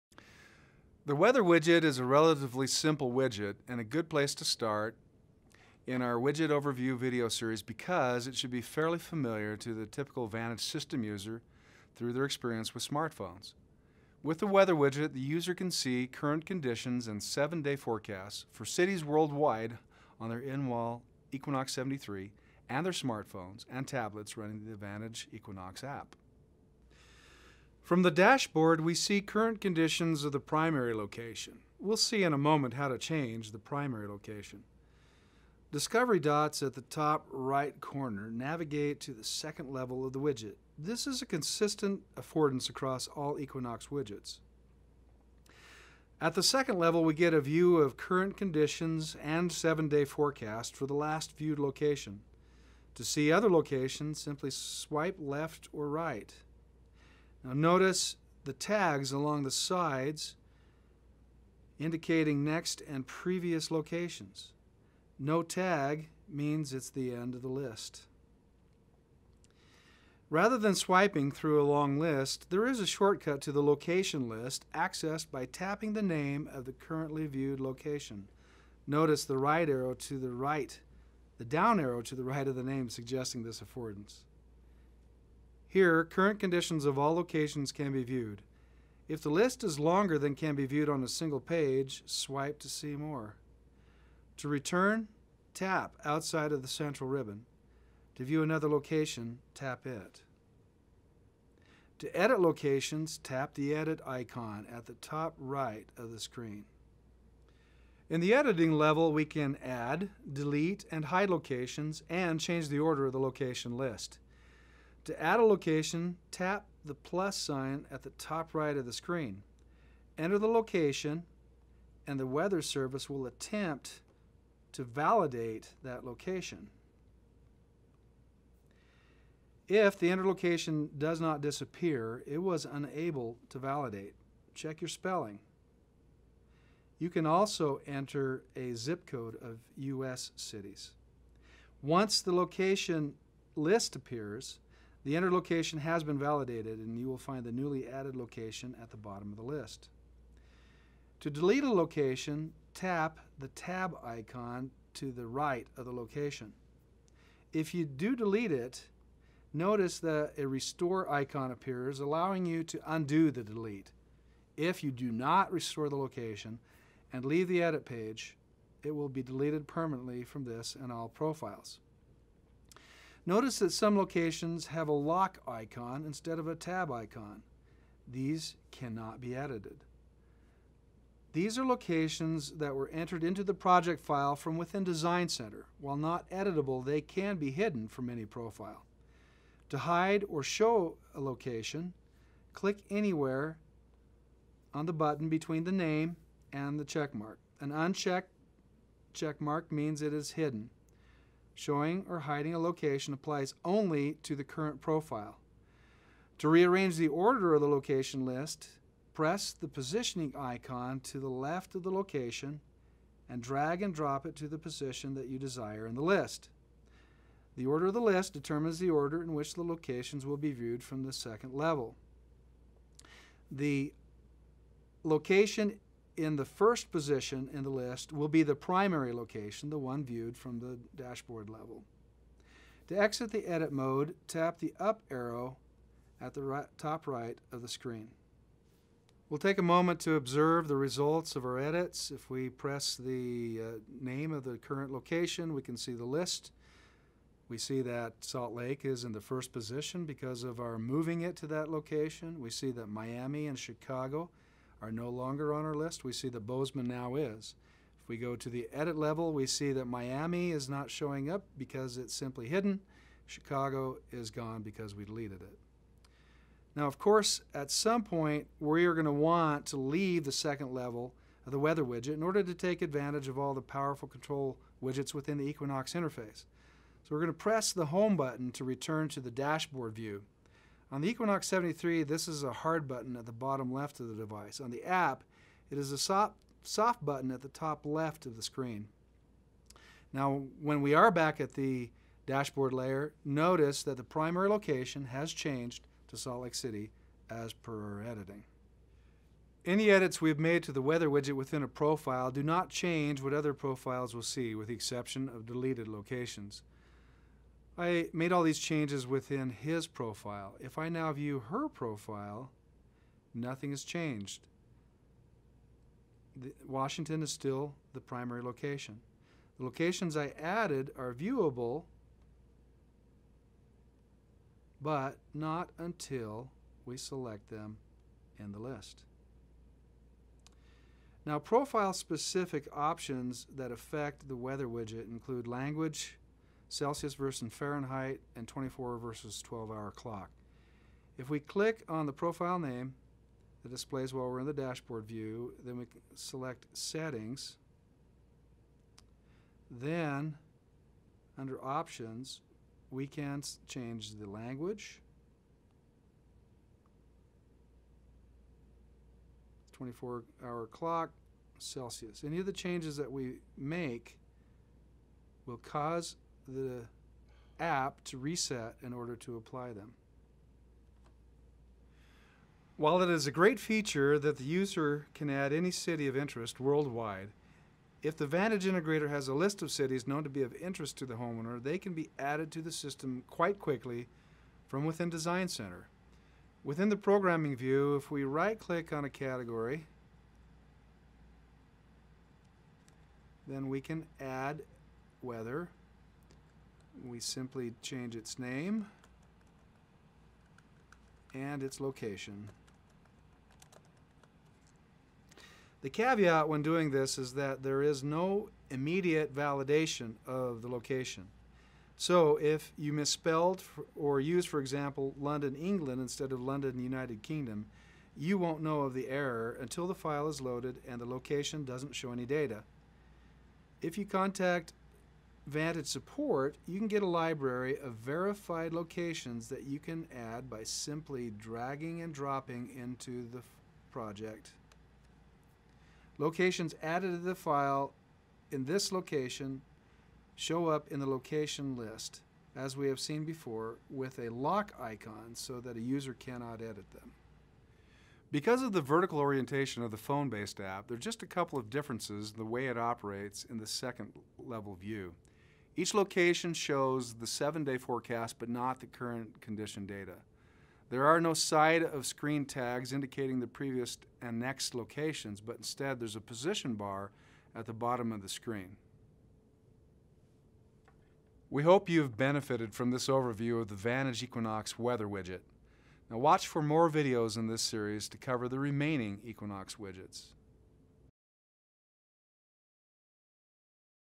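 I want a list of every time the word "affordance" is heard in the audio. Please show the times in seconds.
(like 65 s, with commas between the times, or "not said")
42 s, 83 s.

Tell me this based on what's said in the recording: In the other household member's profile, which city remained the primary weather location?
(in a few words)
Washington.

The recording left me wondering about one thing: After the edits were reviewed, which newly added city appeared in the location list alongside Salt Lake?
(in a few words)
Bozeman.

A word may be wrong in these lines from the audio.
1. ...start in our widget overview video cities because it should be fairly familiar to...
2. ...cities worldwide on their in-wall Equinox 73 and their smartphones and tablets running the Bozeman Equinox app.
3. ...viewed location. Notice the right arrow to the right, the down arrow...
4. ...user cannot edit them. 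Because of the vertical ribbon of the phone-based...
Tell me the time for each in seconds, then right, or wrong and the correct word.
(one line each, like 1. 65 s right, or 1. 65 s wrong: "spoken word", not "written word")
1. 4 s wrong: "series", not "cities"
2. 18 s wrong: "Vantage", not "Bozeman"
3. 77 s right
4. 445 s wrong: "orientation", not "ribbon".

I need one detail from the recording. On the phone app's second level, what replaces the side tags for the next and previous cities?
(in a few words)
position bar.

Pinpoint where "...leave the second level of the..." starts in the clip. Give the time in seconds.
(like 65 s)
269 s.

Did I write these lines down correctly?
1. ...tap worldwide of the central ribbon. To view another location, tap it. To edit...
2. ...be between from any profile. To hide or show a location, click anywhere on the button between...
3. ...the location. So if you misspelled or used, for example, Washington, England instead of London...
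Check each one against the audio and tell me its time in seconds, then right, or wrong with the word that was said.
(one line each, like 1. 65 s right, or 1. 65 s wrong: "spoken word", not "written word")
1. 95 s wrong: "outside", not "worldwide"
2. 187 s wrong: "hidden", not "between"
3. 410 s wrong: "London", not "Washington".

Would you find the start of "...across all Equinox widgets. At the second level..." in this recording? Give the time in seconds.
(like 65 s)
42 s.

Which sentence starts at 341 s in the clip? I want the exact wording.
If we click on the profile name that displays while we're in the dashboard view, then we select Settings.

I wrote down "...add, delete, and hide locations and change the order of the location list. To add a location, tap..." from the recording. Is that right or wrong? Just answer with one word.
right.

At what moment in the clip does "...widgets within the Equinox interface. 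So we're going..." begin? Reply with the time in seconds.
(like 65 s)
274 s.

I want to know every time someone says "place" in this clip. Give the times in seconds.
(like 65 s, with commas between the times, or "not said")
4 s.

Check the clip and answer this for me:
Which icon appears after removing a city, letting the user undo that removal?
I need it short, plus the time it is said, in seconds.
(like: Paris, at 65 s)
restore icon, at 160 s.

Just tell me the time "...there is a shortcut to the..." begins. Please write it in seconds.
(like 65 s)
72 s.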